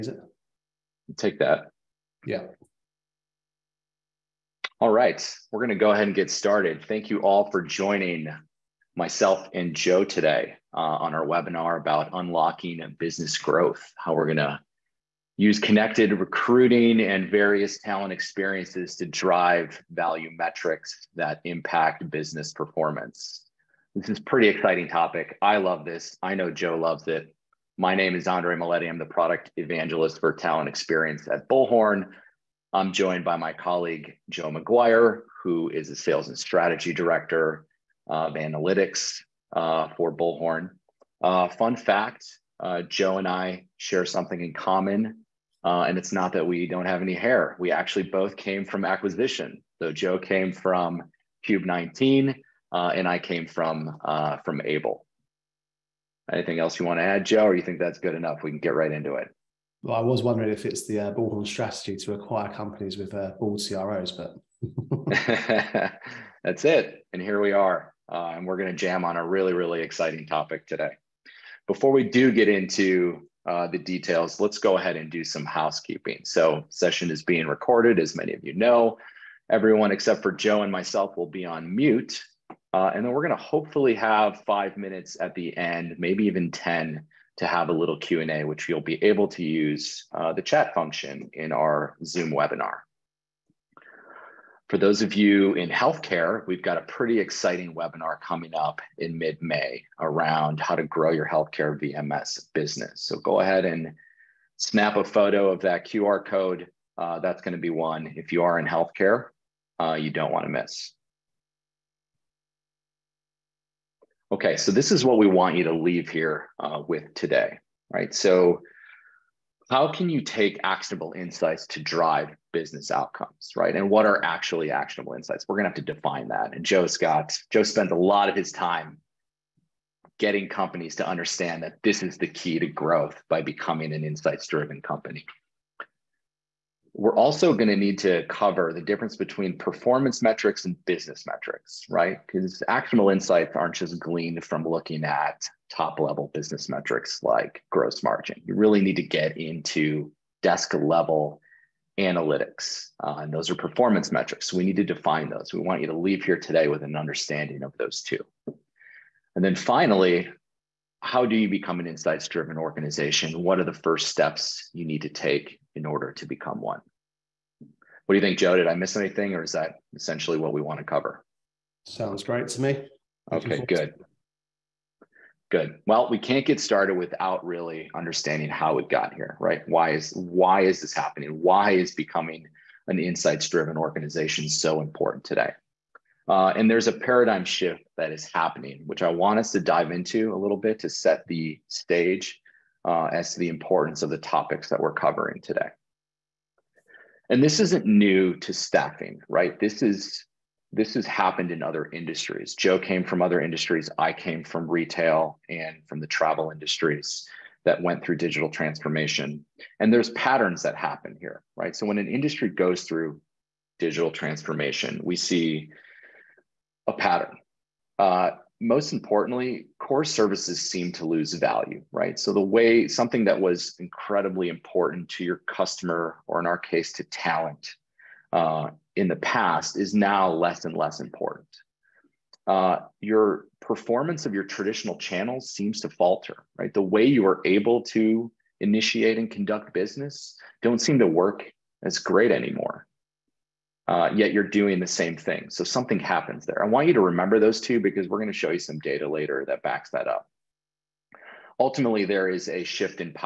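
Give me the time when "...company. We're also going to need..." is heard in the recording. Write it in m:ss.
2:14.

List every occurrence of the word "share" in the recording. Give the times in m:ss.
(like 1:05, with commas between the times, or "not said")
0:43.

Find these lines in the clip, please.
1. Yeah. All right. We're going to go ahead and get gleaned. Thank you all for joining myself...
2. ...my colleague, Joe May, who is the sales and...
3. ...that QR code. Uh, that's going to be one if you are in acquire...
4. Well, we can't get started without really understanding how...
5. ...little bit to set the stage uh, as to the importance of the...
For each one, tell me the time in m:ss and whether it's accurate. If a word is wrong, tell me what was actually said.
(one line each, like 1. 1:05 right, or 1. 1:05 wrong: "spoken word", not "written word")
1. 0:02 wrong: "started", not "gleaned"
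2. 0:33 wrong: "McGuire", not "May"
3. 1:45 wrong: "healthcare", not "acquire"
4. 2:55 right
5. 3:10 right.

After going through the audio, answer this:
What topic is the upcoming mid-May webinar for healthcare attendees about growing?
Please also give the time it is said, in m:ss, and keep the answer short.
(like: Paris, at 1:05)
healthcare VMS business, at 1:41.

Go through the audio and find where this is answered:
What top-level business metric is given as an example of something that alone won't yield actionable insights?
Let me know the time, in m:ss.
2:27.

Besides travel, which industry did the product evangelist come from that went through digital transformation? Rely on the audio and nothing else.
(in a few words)
retail.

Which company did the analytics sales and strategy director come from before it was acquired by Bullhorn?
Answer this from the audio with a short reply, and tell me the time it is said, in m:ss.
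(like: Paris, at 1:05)
Cube 19, at 0:51.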